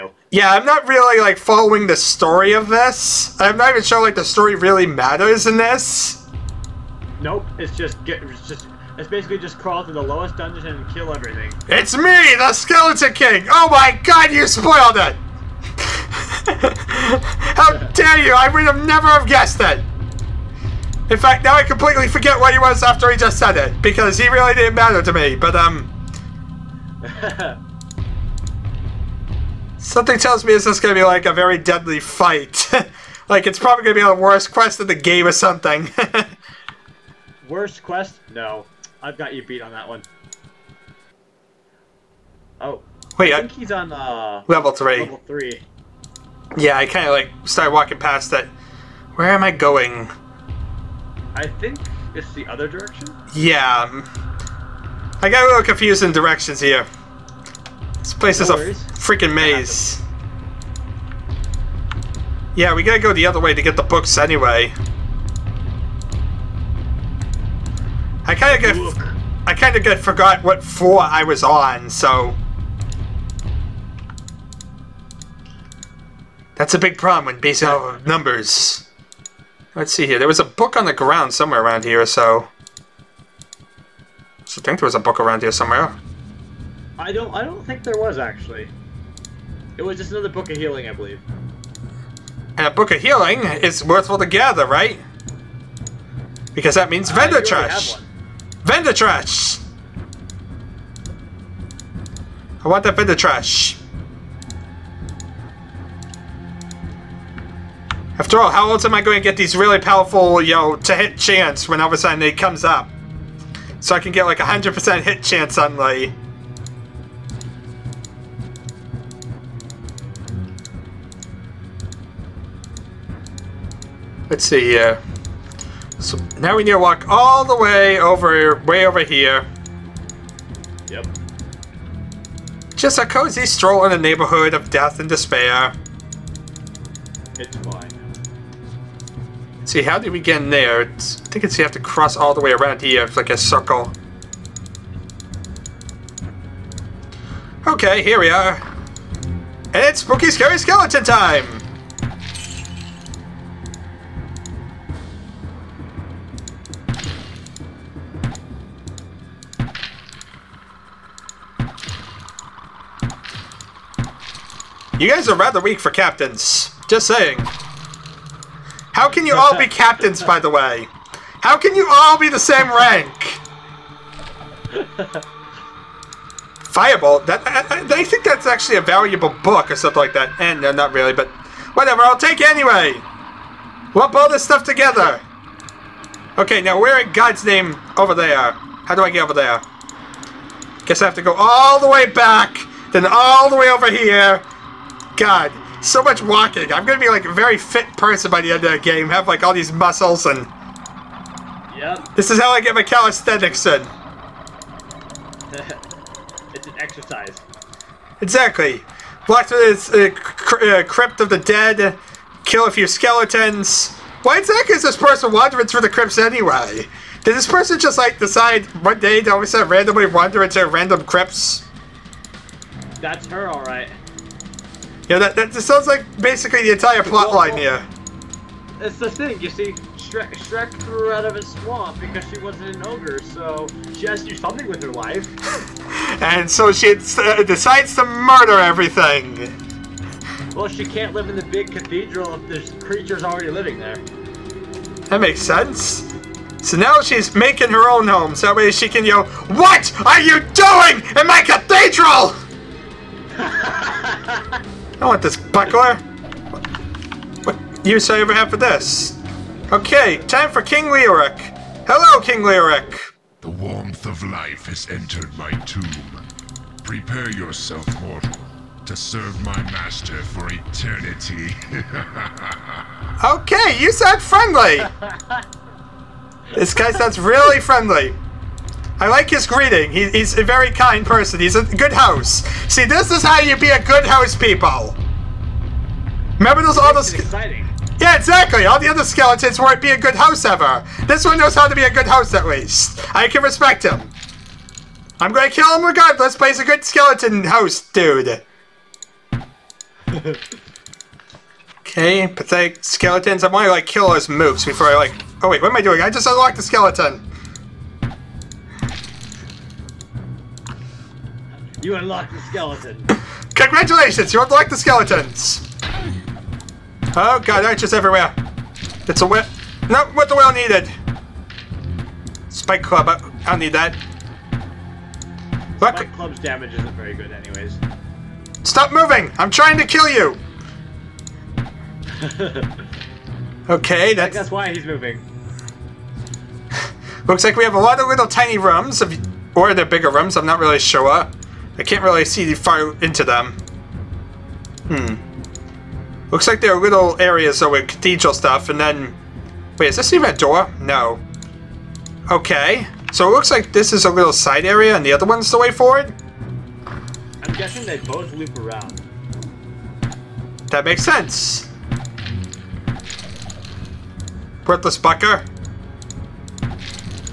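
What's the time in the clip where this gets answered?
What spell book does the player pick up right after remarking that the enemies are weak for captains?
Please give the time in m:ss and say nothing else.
2:56.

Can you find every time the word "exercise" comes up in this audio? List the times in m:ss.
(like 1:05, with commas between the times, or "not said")
3:26.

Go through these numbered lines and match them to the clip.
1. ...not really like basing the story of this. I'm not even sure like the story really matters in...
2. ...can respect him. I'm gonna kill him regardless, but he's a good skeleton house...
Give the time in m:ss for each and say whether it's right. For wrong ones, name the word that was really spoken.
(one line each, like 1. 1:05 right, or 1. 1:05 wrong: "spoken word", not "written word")
1. 0:00 wrong: "following", not "basing"
2. 4:53 right.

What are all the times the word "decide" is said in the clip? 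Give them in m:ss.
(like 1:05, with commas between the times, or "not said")
3:38, 3:57.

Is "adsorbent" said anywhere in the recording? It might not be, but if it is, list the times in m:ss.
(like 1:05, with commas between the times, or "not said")
not said.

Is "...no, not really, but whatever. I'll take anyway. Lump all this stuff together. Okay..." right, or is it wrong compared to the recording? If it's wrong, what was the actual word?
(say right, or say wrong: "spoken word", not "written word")
right.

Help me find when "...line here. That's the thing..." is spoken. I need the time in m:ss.
3:47.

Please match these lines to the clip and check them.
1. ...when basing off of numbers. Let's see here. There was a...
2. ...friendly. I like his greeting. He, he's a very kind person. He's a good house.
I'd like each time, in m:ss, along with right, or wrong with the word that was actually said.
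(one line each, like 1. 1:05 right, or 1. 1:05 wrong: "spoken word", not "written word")
1. 1:17 right
2. 4:37 right.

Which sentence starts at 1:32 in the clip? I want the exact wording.
And a Book of Healing is worthful to gather, right?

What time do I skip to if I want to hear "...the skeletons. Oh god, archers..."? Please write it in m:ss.
5:14.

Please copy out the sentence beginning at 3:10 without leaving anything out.
Guess I have to go all the way back, then all the way over here, God, so much walking.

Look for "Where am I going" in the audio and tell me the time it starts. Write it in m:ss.
0:49.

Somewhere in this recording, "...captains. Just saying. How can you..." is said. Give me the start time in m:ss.
2:45.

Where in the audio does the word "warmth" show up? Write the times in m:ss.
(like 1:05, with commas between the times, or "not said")
4:23.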